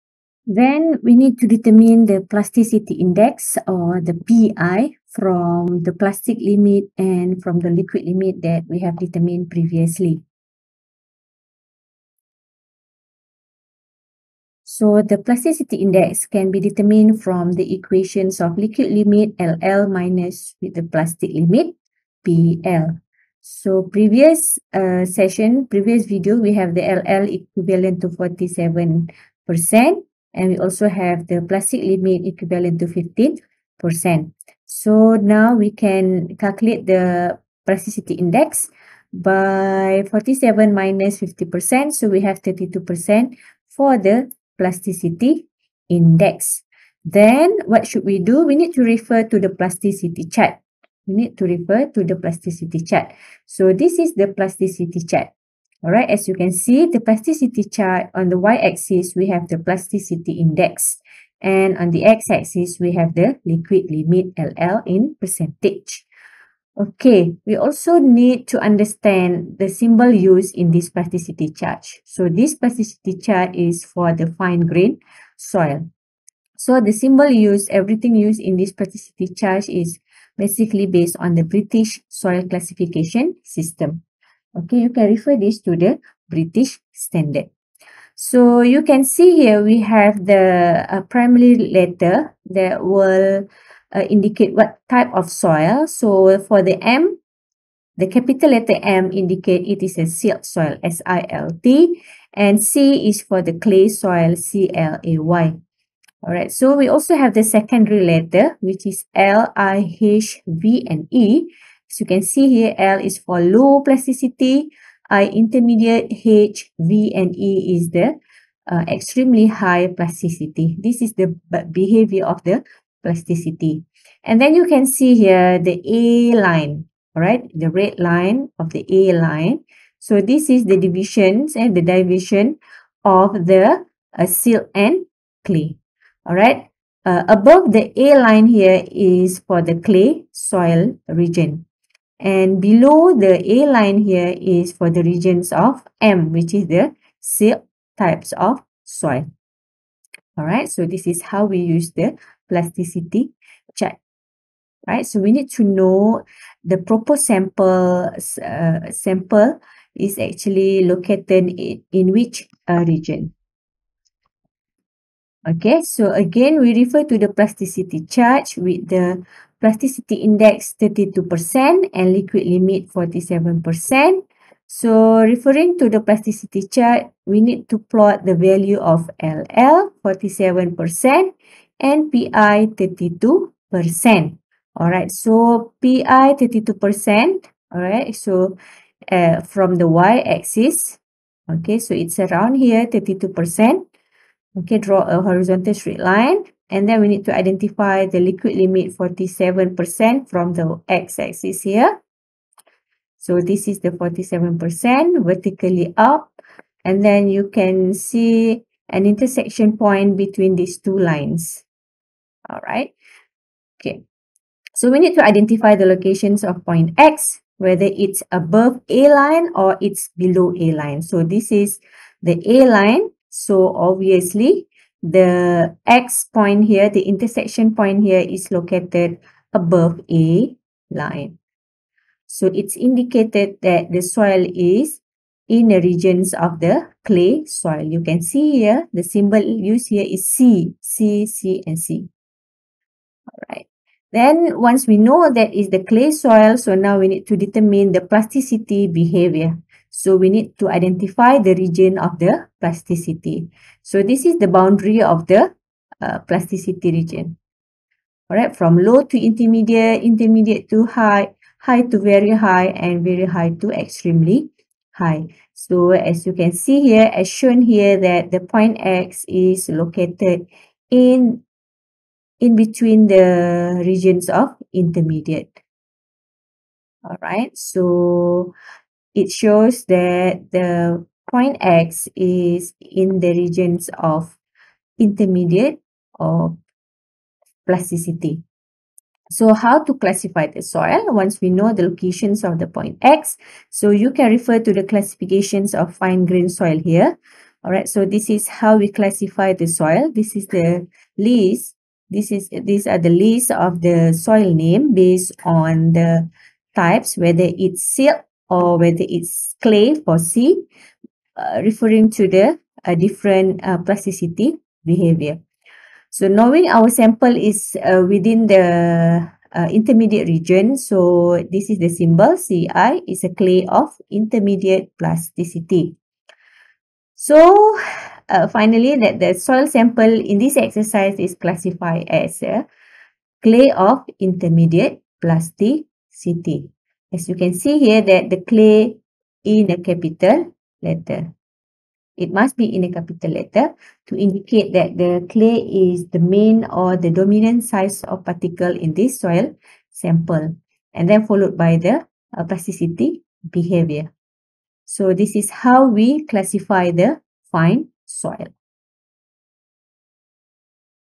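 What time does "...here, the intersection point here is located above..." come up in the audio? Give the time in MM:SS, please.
03:46.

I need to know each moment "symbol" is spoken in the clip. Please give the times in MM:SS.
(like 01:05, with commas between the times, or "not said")
01:09, 01:16, 03:59, 05:21.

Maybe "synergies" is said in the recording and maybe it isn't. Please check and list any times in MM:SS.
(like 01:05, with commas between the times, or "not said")
not said.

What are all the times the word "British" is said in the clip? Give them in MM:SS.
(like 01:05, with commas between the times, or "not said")
01:21, 01:26.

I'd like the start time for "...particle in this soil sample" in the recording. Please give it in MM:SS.
05:48.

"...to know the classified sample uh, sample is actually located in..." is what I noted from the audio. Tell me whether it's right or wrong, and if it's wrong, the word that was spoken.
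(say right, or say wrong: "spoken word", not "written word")
wrong: "proposed", not "classified".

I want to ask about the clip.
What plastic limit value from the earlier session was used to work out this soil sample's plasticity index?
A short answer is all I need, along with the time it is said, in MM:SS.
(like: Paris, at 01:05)
15%, at 00:32.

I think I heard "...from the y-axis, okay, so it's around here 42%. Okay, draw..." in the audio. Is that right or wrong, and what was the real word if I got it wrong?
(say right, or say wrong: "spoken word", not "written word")
wrong: "32", not "42".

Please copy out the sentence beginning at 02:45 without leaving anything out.
Okay, so again, we refer to the plasticity chart with the plasticity index 32% and liquid limit 47%.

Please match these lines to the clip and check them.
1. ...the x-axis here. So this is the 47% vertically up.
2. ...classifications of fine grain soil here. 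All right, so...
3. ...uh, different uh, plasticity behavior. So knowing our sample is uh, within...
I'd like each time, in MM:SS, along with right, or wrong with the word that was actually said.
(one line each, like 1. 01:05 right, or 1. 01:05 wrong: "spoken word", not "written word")
1. 03:20 right
2. 04:54 right
3. 05:12 right.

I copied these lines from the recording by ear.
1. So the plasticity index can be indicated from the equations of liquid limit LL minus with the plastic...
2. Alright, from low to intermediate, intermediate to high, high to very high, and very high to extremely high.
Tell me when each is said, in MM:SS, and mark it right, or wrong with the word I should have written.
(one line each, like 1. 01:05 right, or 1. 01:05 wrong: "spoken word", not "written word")
1. 00:14 wrong: "determined", not "indicated"
2. 04:18 right.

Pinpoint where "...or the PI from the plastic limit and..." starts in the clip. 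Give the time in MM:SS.
00:03.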